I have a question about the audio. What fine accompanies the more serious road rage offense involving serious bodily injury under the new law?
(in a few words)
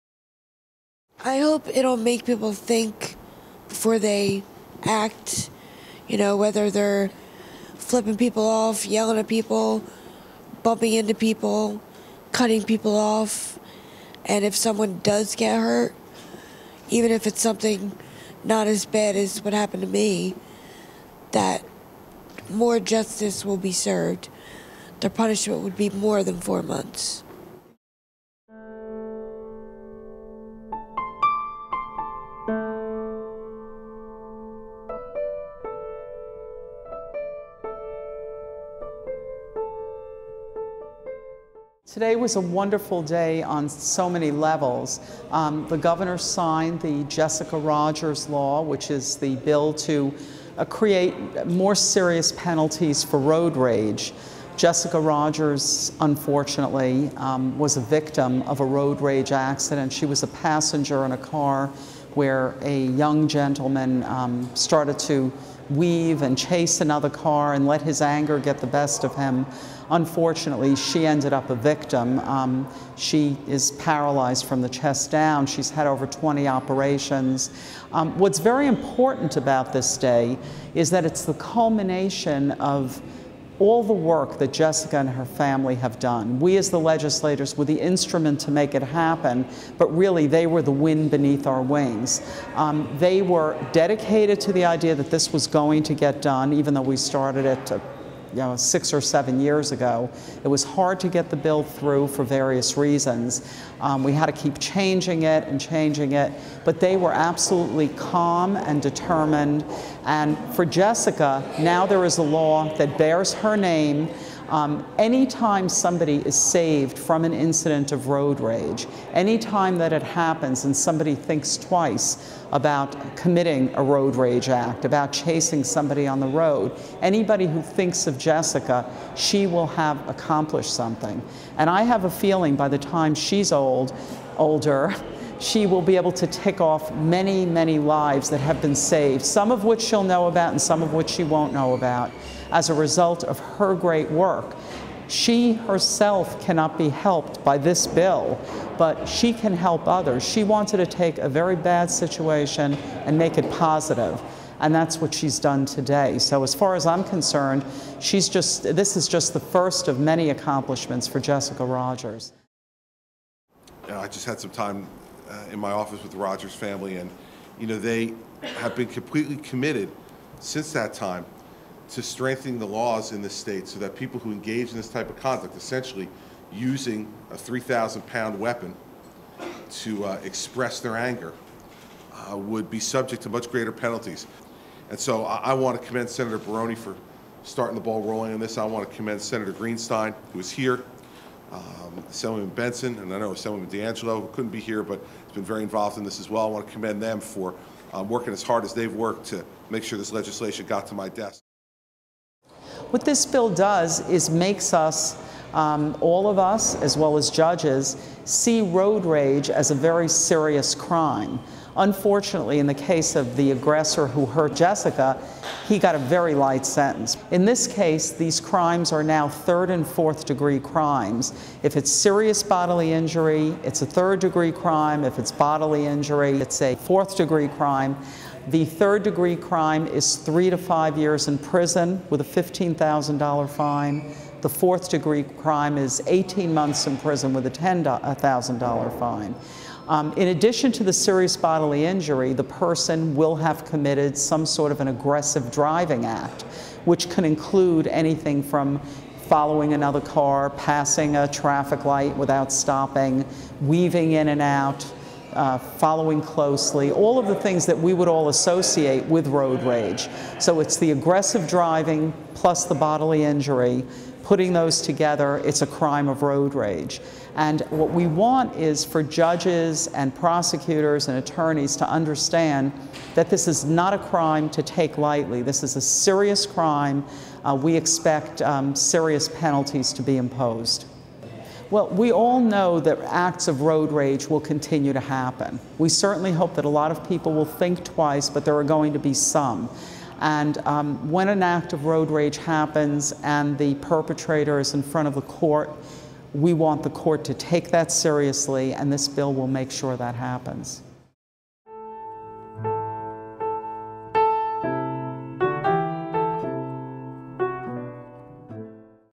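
$15,000.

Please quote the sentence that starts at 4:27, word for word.
And what we want is for judges and prosecutors and attorneys to understand that this is not a crime to take lightly.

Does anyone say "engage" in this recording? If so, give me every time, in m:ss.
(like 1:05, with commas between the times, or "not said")
2:54.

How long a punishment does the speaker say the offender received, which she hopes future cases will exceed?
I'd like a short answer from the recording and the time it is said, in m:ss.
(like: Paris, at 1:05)
4 months, at 0:26.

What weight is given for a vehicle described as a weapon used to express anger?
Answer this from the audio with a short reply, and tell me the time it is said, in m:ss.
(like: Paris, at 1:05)
3,000 pounds, at 2:57.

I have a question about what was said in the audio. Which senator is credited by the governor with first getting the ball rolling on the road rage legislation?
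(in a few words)
Senator Baroni.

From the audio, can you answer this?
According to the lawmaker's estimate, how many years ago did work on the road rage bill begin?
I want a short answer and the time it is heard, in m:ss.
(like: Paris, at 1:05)
6 or 7 years, at 1:38.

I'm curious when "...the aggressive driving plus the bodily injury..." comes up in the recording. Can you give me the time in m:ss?
4:20.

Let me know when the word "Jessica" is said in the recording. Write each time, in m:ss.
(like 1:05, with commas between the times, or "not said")
0:47, 0:54, 1:24, 1:50, 2:08, 2:41, 3:34.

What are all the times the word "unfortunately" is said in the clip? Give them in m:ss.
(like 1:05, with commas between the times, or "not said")
0:55, 1:09, 3:31.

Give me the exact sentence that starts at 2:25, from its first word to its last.
She herself cannot be helped by this bill, but she can help others.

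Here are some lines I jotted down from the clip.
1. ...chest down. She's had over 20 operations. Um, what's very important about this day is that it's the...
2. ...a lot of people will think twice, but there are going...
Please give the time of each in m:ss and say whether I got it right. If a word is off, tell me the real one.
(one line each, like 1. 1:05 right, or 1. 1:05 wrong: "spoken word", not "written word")
1. 1:14 right
2. 4:46 right.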